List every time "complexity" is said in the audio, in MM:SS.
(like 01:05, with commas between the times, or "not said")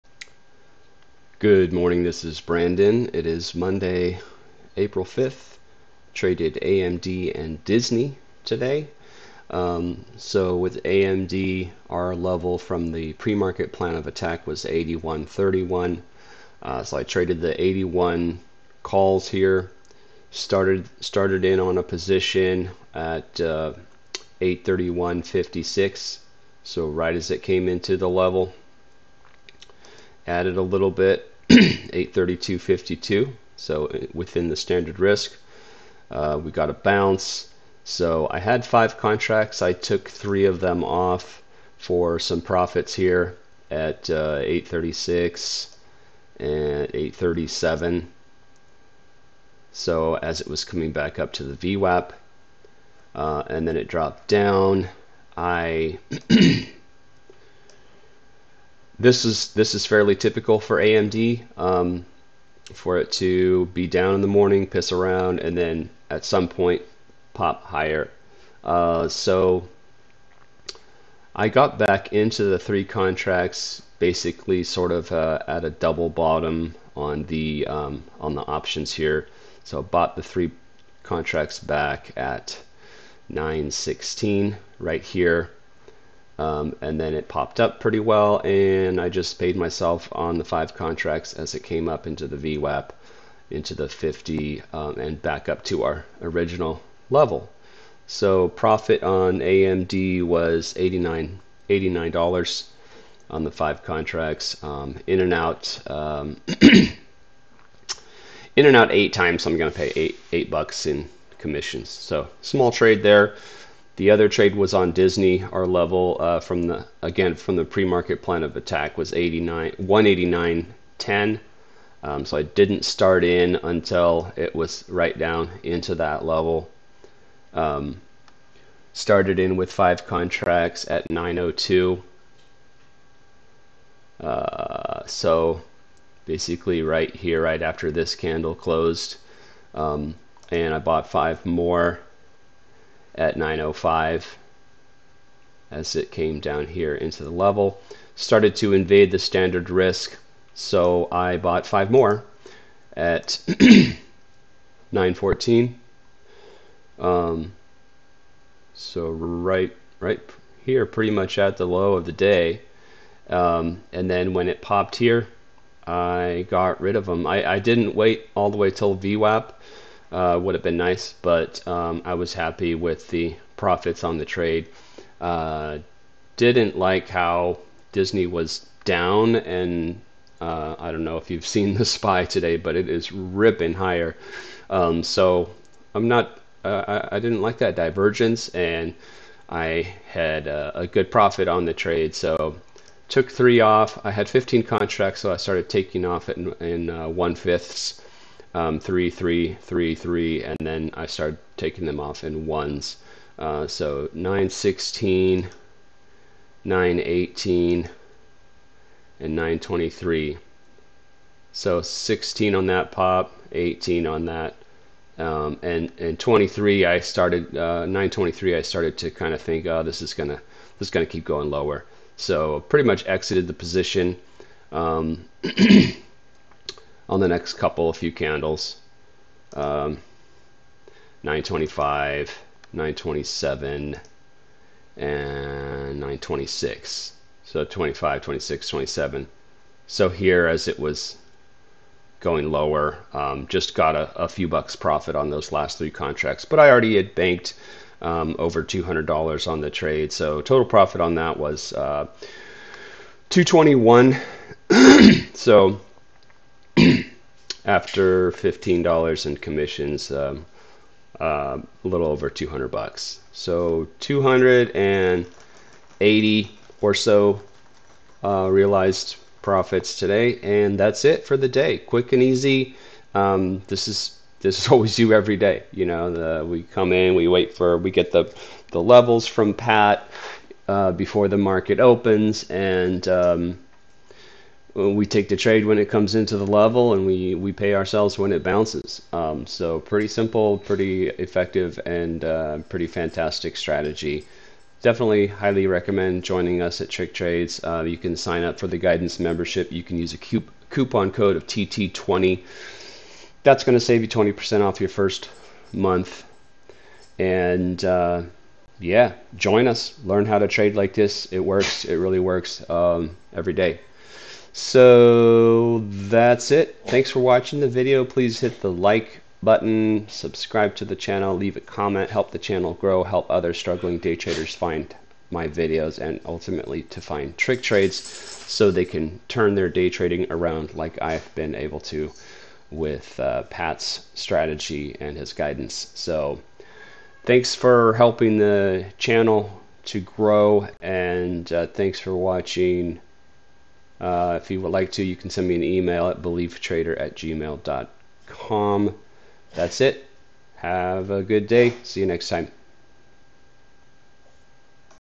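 not said.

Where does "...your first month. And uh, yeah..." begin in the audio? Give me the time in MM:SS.
05:04.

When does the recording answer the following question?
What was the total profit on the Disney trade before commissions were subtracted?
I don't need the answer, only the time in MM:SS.
04:13.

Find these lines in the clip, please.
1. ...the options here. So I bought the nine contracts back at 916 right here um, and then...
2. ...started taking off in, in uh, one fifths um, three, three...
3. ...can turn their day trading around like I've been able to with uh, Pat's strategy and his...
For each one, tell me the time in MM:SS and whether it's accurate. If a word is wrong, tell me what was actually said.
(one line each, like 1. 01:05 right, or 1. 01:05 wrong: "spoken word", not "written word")
1. 01:18 wrong: "three", not "nine"
2. 03:15 right
3. 05:28 right.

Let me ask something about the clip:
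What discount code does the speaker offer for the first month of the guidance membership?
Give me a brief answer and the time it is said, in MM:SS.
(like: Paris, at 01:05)
TT20, at 05:01.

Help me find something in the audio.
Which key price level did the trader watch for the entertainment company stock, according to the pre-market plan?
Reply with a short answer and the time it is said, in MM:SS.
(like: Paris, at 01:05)
189.10, at 01:59.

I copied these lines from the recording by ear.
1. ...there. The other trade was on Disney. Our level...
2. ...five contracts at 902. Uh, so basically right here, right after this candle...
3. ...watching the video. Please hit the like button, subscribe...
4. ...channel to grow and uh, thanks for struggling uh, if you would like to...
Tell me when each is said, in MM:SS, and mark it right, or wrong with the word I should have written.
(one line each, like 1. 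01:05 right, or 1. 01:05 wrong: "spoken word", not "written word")
1. 01:53 right
2. 02:09 right
3. 05:17 right
4. 05:38 wrong: "watching", not "struggling".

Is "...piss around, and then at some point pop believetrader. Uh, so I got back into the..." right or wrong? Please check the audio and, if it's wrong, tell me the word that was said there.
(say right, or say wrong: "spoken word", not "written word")
wrong: "higher", not "believetrader".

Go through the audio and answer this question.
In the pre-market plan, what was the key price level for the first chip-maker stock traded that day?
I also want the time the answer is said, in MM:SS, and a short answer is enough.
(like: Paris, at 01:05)
81.31, at 00:14.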